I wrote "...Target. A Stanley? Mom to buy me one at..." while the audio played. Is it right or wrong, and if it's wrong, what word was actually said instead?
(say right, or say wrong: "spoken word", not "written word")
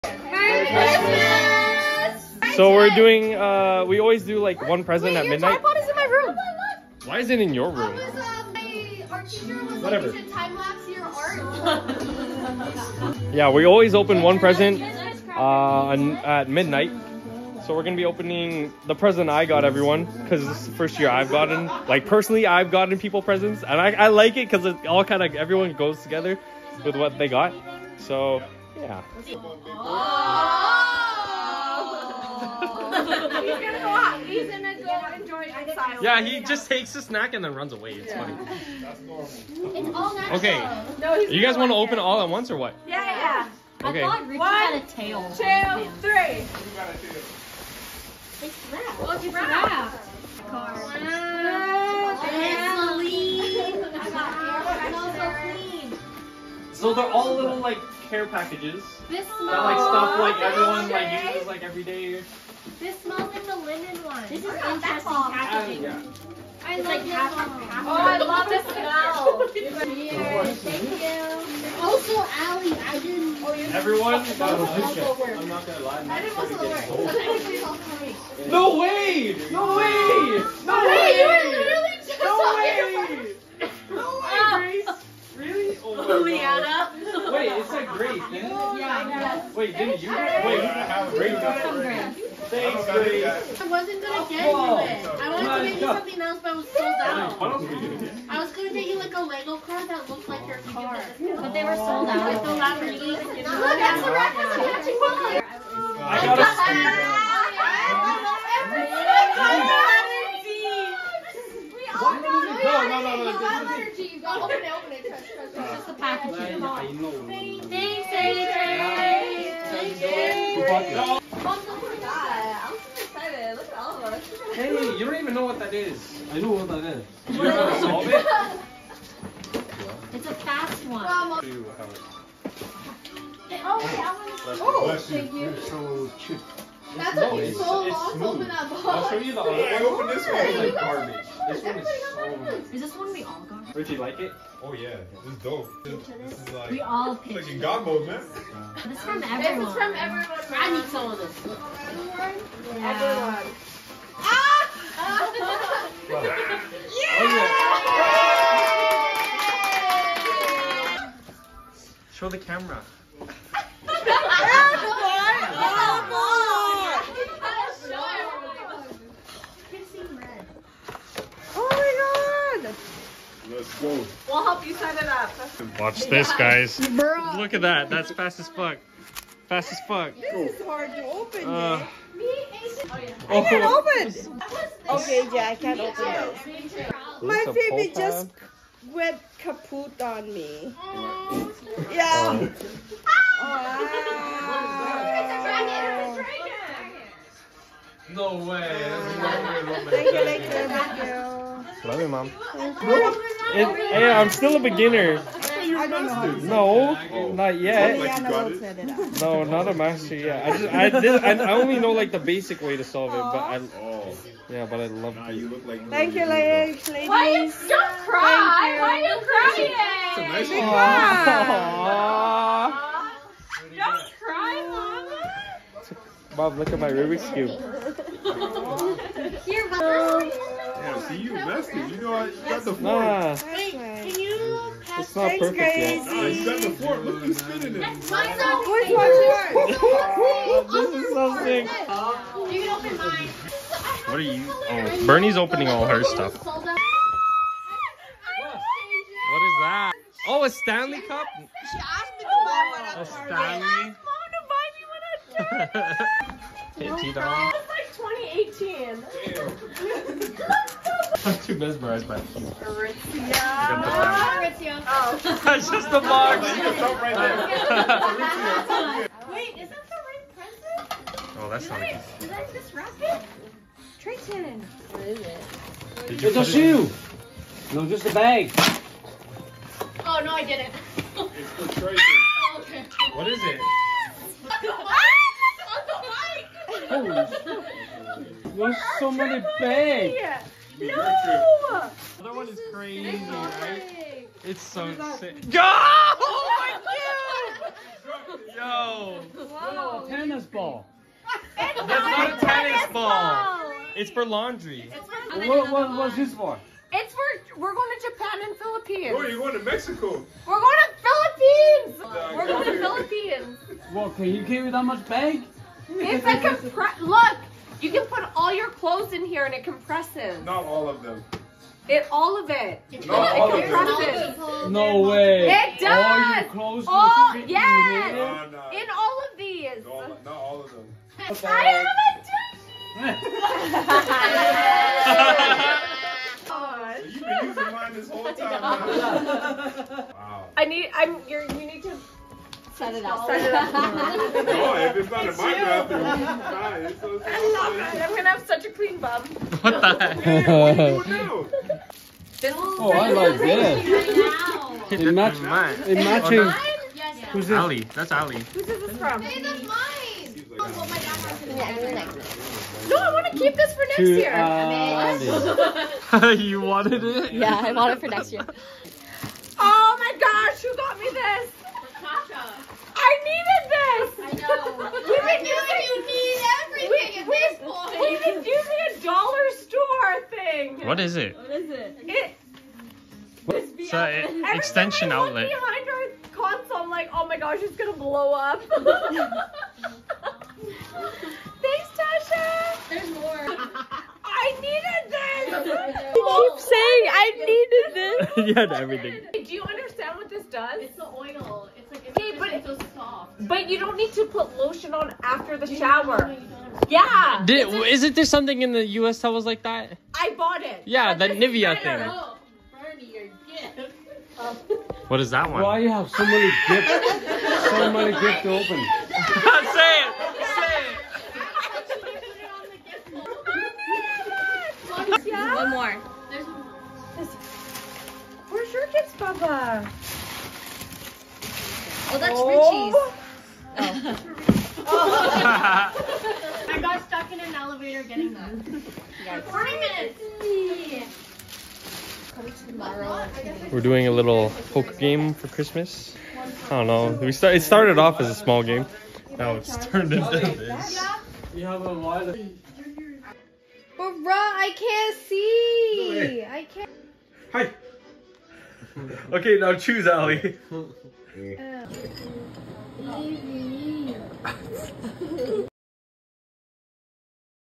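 right.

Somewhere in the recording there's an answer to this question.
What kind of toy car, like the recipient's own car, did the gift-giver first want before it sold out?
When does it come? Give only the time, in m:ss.
1:39.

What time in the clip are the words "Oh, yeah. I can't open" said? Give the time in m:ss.
3:03.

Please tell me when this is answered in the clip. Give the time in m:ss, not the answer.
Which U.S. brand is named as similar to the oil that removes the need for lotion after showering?
6:51.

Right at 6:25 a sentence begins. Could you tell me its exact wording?
Behind our console, I'm like, oh my gosh, it's gonna blow up.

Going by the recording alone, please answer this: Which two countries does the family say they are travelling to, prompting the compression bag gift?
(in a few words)
Japan and Philippines.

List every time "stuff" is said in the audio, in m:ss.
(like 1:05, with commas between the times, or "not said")
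0:59, 4:06.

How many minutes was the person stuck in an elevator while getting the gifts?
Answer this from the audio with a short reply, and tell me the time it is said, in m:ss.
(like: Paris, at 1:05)
40, at 7:19.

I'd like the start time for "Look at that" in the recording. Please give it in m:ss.
2:57.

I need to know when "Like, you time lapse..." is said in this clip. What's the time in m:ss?
0:10.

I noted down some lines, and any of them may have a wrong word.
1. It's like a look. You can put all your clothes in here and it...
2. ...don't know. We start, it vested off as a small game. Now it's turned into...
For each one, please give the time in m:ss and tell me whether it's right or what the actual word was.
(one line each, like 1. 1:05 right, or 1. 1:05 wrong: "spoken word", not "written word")
1. 5:15 right
2. 7:26 wrong: "started", not "vested".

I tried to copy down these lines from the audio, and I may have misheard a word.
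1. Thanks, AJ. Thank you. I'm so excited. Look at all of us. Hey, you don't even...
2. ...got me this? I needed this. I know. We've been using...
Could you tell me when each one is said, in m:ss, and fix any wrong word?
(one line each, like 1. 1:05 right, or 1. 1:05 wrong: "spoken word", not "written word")
1. 1:57 right
2. 6:10 right.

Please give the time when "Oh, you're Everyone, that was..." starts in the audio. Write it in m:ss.
1:13.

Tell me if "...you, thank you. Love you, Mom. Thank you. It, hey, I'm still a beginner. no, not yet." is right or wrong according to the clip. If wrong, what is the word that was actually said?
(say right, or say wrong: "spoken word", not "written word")
right.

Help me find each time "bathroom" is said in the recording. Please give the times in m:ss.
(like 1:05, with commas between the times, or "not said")
5:45.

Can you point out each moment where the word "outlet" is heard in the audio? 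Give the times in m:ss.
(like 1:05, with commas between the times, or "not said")
6:25.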